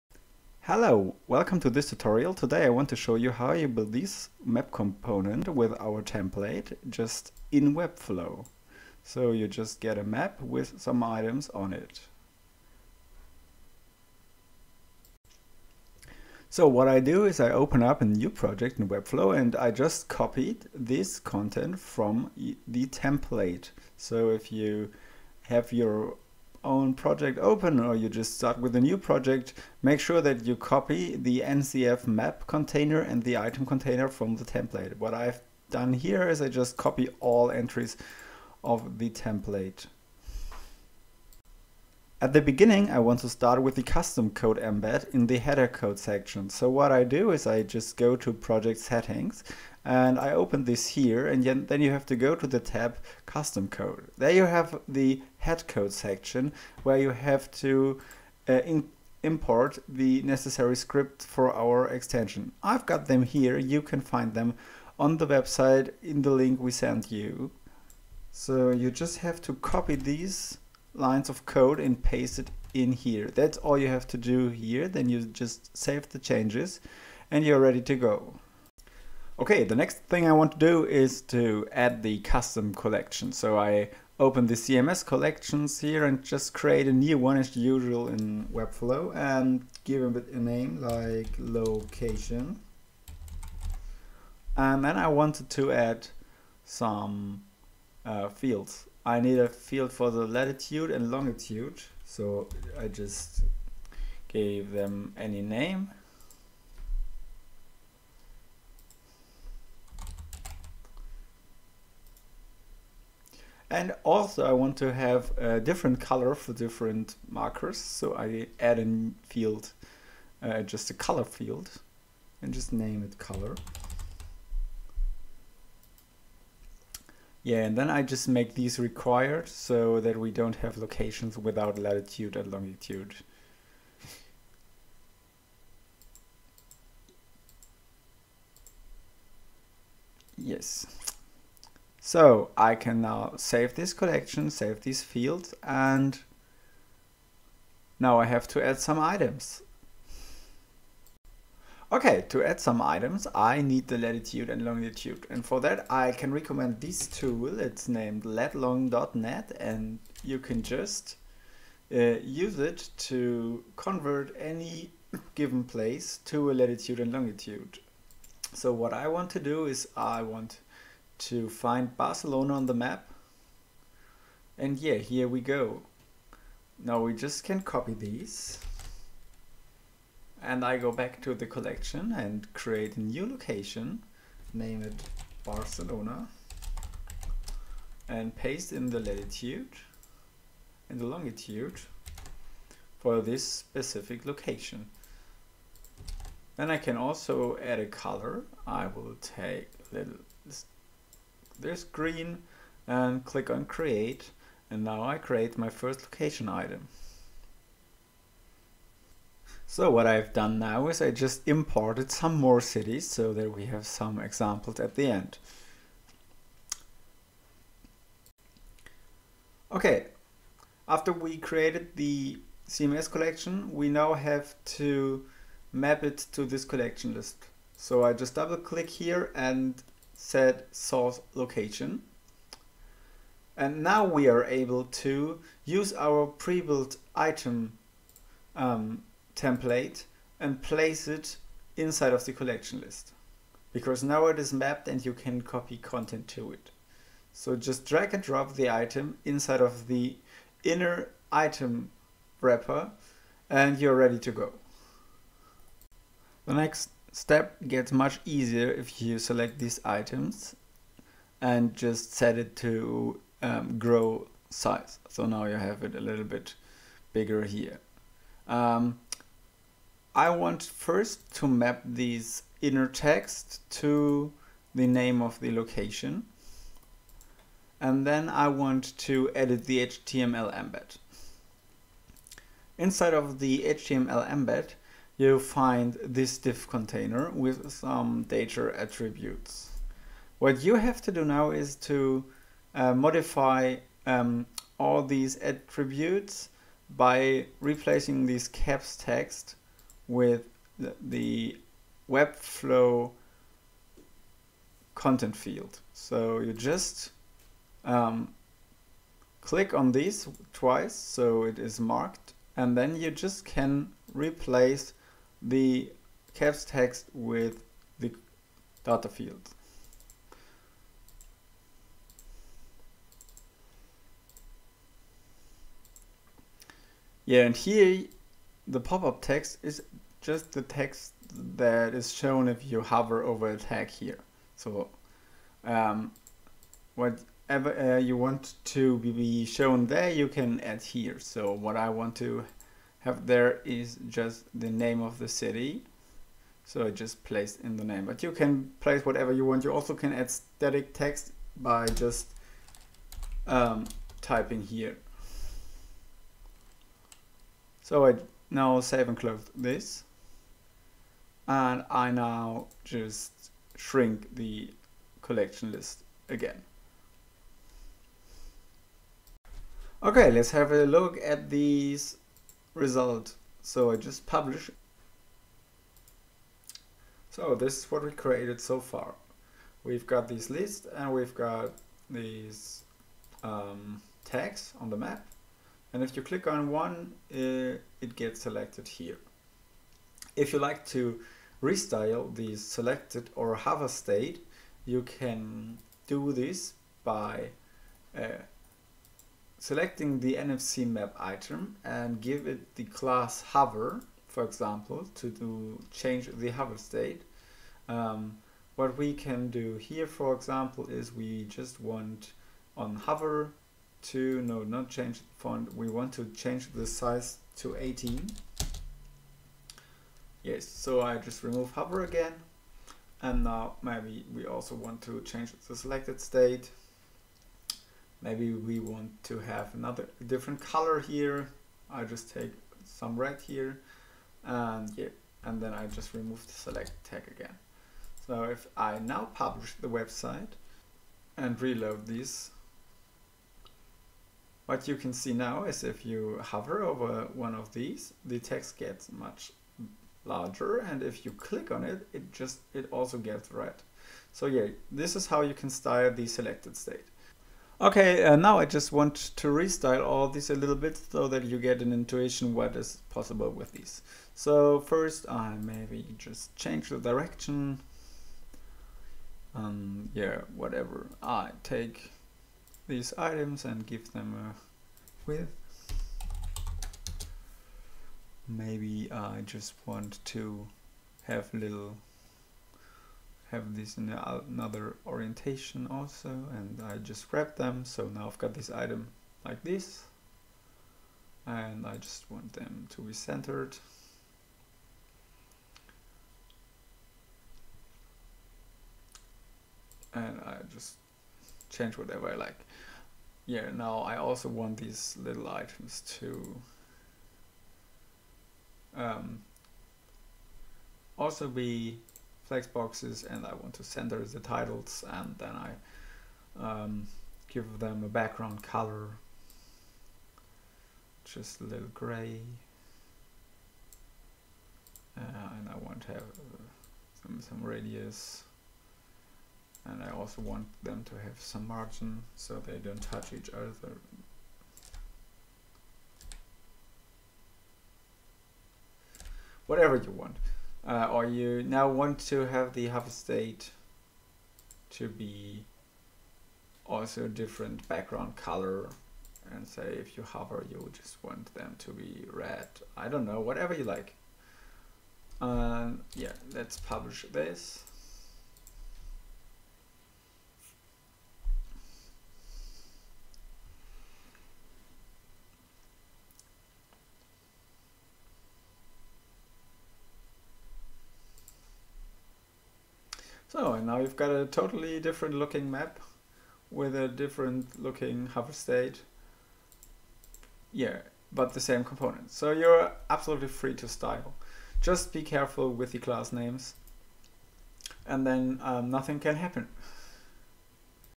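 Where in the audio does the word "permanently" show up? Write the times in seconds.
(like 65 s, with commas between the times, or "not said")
not said.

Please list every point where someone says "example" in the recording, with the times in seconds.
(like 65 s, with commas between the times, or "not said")
214 s, 404 s, 410 s.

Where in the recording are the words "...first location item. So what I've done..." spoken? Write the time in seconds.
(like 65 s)
205 s.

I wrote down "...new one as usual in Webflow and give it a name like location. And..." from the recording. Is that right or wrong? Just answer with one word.
right.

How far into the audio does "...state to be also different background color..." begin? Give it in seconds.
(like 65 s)
543 s.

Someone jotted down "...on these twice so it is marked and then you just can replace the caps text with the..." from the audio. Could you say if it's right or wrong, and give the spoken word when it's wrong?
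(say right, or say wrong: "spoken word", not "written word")
right.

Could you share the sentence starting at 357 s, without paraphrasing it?
So I now save and close this.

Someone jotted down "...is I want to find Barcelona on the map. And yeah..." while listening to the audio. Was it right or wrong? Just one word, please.
right.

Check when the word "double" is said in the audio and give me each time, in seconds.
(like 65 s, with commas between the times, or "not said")
228 s.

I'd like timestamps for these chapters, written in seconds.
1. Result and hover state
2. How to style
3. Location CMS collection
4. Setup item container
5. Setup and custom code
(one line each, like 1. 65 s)
1. 370 s
2. 464 s
3. 85 s
4. 240 s
5. 15 s.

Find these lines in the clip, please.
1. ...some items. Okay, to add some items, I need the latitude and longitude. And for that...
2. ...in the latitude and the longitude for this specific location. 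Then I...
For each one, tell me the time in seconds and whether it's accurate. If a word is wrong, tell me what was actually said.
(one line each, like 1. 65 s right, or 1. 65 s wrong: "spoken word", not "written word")
1. 148 s right
2. 188 s right.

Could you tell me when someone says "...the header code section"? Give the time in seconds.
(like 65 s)
45 s.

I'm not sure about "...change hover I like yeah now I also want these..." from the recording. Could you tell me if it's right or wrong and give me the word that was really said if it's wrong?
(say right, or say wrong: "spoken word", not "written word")
wrong: "whatever", not "hover".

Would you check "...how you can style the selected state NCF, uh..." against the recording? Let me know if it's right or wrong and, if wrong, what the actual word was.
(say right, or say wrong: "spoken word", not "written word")
wrong: "Okay", not "NCF".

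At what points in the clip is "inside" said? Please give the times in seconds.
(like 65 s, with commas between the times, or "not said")
241 s, 249 s, 282 s.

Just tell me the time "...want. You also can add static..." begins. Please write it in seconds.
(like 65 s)
349 s.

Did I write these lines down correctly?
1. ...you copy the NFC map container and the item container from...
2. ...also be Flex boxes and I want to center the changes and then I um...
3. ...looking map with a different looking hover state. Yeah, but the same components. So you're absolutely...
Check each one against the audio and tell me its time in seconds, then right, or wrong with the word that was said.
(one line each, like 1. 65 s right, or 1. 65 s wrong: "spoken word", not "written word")
1. 30 s wrong: "NCF", not "NFC"
2. 511 s wrong: "titles", not "changes"
3. 575 s right.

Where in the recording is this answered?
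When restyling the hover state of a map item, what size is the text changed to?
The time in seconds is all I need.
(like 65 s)
417 s.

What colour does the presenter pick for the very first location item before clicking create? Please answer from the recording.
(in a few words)
green.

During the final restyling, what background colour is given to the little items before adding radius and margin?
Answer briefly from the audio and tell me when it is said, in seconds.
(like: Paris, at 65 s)
gray, at 521 s.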